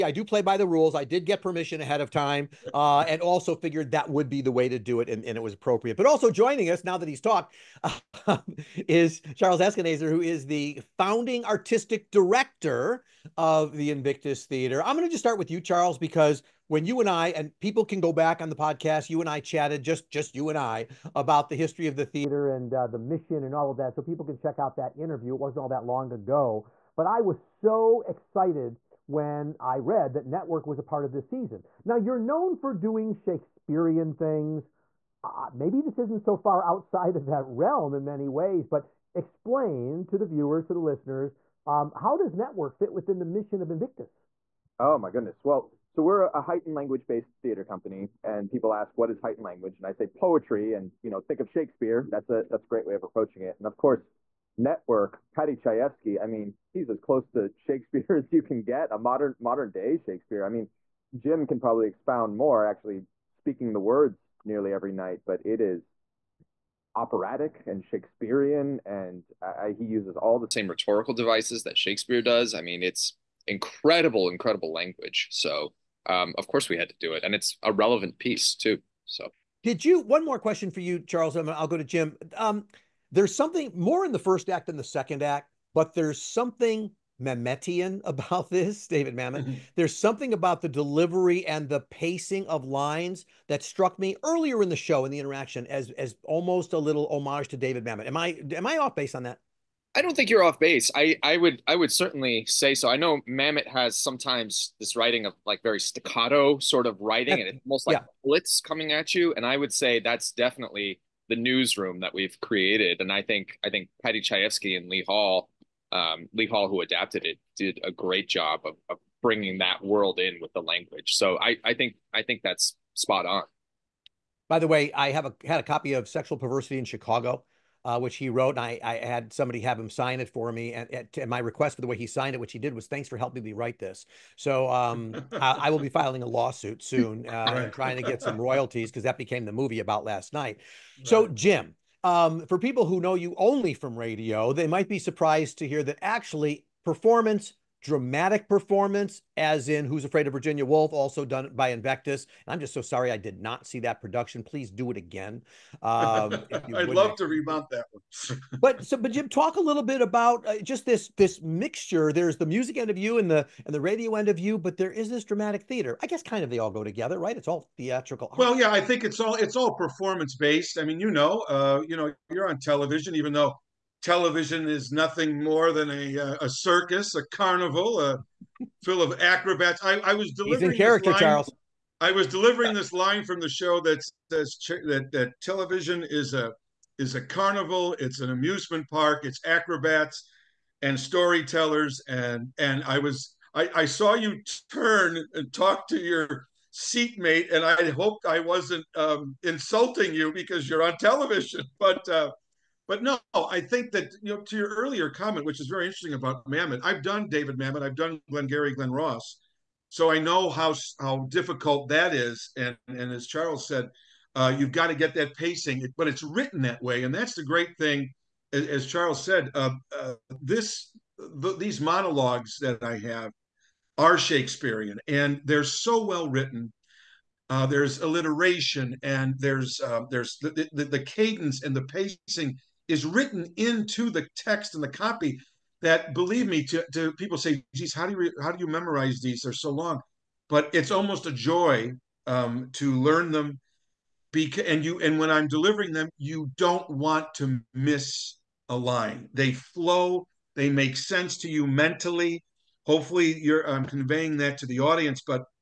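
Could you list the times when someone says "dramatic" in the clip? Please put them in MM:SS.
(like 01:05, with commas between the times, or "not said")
02:27, 02:45.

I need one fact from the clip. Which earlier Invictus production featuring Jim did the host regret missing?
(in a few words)
Who's Afraid of Virginia Woolf.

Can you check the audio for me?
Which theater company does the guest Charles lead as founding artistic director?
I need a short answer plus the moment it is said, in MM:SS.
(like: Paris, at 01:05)
Invictus Theater, at 00:13.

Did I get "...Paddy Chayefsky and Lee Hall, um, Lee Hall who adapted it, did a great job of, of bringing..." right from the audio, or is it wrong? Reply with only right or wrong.
right.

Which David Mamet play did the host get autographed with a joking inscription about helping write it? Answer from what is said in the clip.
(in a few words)
Sexual Perversity in Chicago.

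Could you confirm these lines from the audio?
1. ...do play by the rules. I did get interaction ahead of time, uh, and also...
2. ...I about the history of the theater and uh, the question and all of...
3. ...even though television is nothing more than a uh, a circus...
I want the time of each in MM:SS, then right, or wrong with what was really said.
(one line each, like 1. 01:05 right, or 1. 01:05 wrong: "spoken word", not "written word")
1. 00:00 wrong: "permission", not "interaction"
2. 00:20 wrong: "mission", not "question"
3. 02:53 right.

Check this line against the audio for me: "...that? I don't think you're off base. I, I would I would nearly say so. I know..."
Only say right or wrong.
wrong.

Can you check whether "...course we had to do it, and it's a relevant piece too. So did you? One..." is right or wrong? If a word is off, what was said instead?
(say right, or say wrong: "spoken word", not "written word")
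right.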